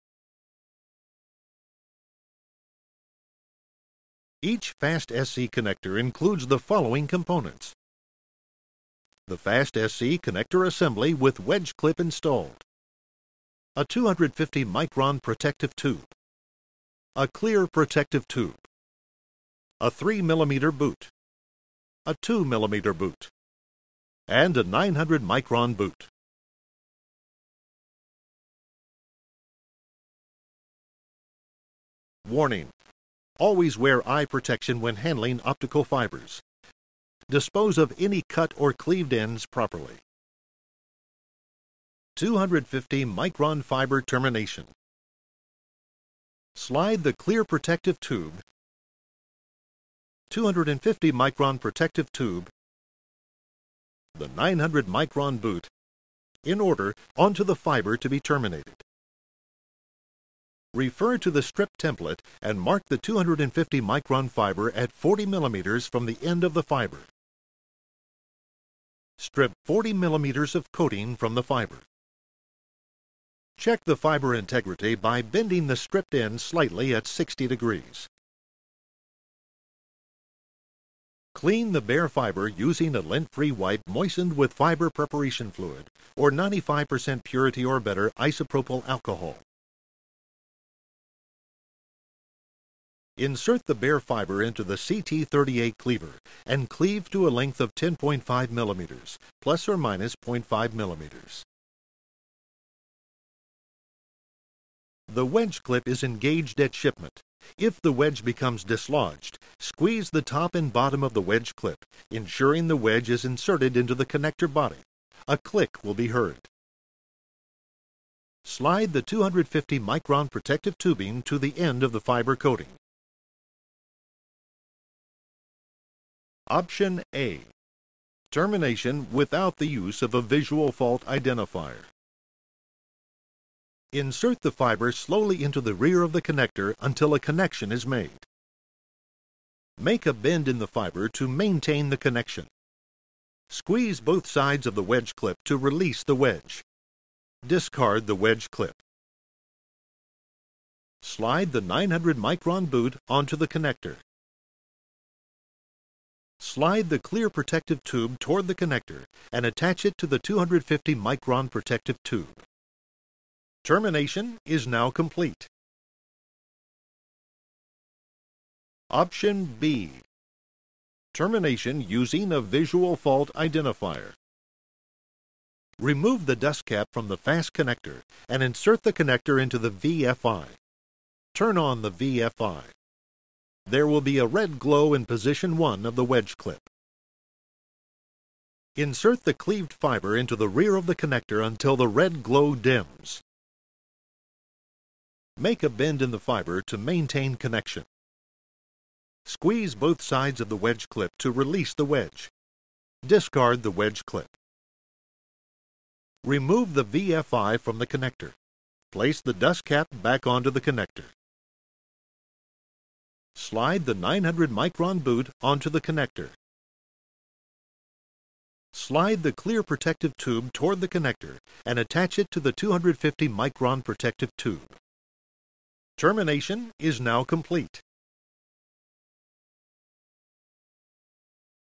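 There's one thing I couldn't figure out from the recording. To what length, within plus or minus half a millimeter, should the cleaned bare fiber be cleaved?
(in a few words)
10.5 mm.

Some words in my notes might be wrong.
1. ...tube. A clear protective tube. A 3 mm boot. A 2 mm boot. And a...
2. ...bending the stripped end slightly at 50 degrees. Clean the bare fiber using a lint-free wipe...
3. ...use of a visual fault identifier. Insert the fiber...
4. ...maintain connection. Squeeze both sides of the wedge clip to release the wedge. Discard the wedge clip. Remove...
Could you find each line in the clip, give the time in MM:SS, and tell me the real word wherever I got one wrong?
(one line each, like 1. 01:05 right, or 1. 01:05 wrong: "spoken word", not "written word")
1. 00:15 right
2. 01:15 wrong: "60", not "50"
3. 02:09 right
4. 03:16 right.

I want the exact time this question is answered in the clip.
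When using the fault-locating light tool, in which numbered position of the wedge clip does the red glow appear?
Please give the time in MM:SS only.
03:05.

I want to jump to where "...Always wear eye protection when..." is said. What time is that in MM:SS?
00:33.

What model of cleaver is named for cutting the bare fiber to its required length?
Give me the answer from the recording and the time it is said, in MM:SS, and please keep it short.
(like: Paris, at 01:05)
CT38, at 01:34.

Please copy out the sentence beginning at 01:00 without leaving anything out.
Refer to the strip template and mark the 250 micron fiber at 40 millimeters from the end of the fiber.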